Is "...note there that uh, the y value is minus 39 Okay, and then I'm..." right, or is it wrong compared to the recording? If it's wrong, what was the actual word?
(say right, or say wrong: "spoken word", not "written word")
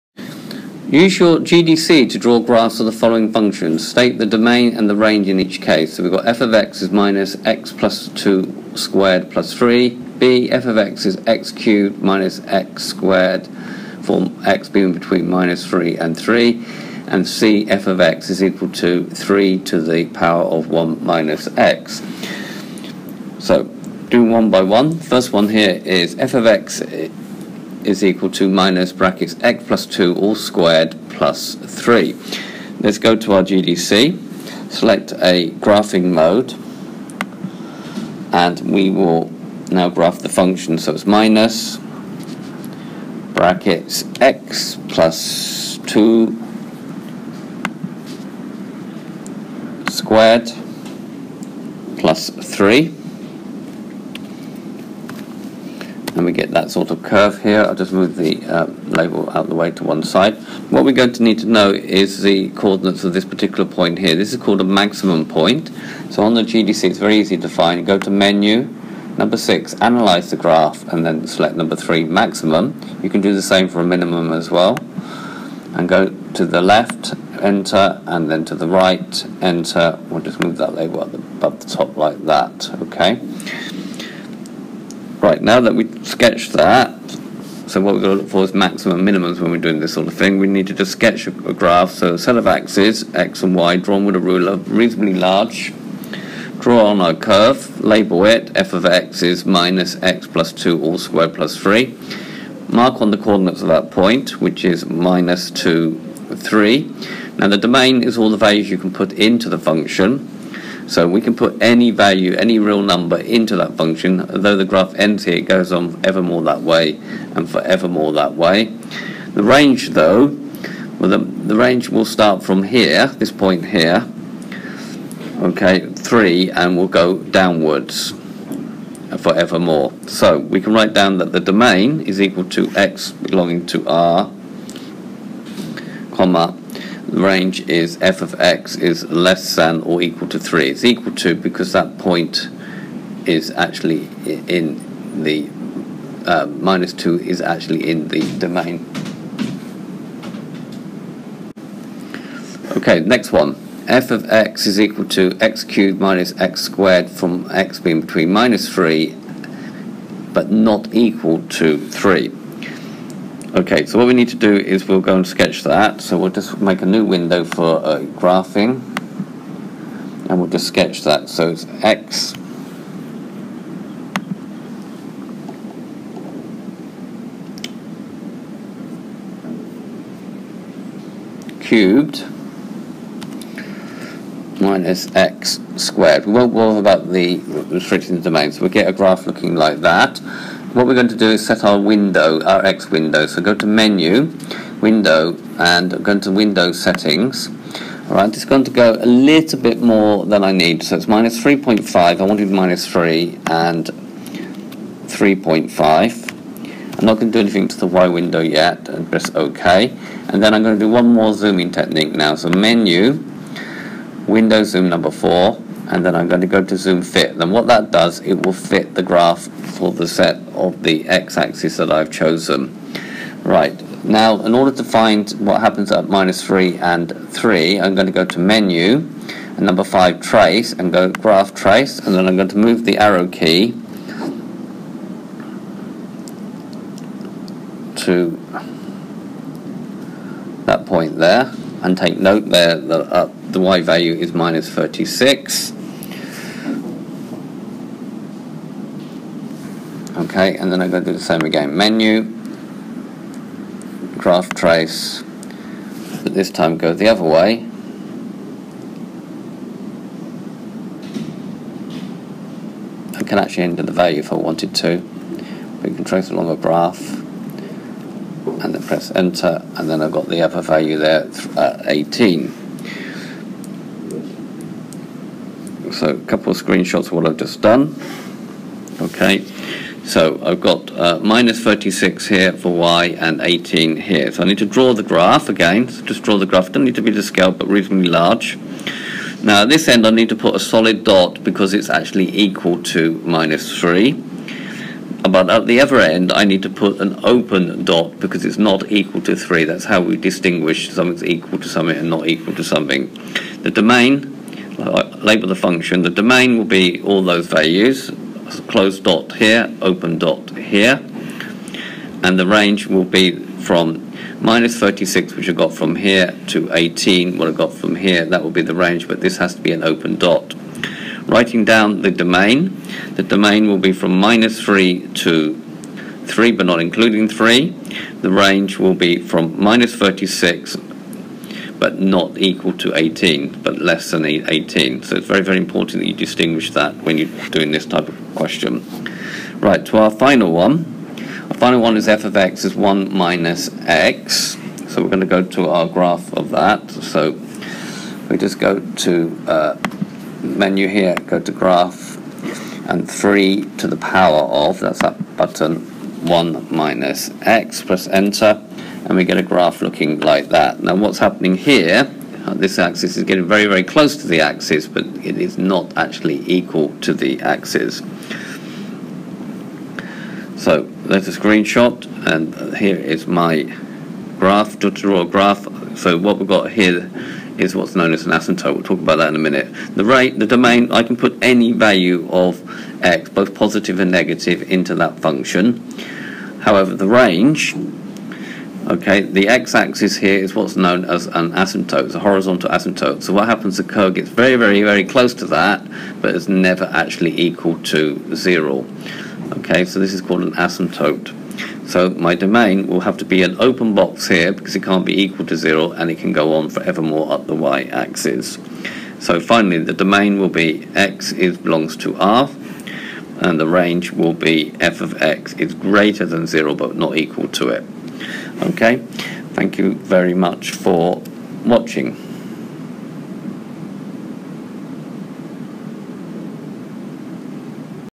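wrong: "36", not "39".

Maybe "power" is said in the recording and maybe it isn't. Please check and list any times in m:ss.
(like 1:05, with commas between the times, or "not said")
0:20, 5:53.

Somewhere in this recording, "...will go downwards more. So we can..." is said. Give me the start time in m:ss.
2:06.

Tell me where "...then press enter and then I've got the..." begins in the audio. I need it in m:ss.
4:28.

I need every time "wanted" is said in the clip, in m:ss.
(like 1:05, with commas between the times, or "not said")
3:22, 4:24.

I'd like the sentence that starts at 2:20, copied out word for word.
It's equal to because that point is actually in the uh, minus 2 is actually in the domain.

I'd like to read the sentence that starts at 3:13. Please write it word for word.
So go to menu, window, and go to window settings.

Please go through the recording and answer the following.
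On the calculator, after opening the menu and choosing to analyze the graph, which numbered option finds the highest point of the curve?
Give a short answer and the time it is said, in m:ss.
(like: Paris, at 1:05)
3, at 1:11.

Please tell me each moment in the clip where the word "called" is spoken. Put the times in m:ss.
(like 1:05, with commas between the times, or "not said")
1:04, 6:40.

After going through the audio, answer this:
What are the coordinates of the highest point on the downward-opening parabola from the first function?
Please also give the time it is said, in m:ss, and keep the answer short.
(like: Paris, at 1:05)
(-2, 3), at 1:44.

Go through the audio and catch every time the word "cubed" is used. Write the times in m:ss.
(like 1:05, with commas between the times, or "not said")
0:11, 2:35, 3:01.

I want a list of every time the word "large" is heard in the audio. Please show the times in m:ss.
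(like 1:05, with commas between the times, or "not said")
1:35, 4:48.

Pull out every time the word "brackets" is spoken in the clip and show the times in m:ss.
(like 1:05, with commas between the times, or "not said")
0:28, 0:43.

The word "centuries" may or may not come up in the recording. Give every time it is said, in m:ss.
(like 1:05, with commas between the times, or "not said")
not said.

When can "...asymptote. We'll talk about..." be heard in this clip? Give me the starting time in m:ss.
6:18.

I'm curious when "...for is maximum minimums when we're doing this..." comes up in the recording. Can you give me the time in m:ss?
1:28.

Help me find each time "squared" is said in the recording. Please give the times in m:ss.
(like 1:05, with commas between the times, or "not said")
0:08, 0:12, 0:30, 0:49, 1:40, 2:36, 3:05.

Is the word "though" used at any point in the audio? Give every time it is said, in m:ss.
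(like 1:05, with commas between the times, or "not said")
1:54, 1:59.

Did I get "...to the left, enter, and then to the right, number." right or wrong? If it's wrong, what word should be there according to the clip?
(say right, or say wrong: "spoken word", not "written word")
wrong: "enter", not "number".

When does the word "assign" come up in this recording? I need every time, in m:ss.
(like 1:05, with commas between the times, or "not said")
not said.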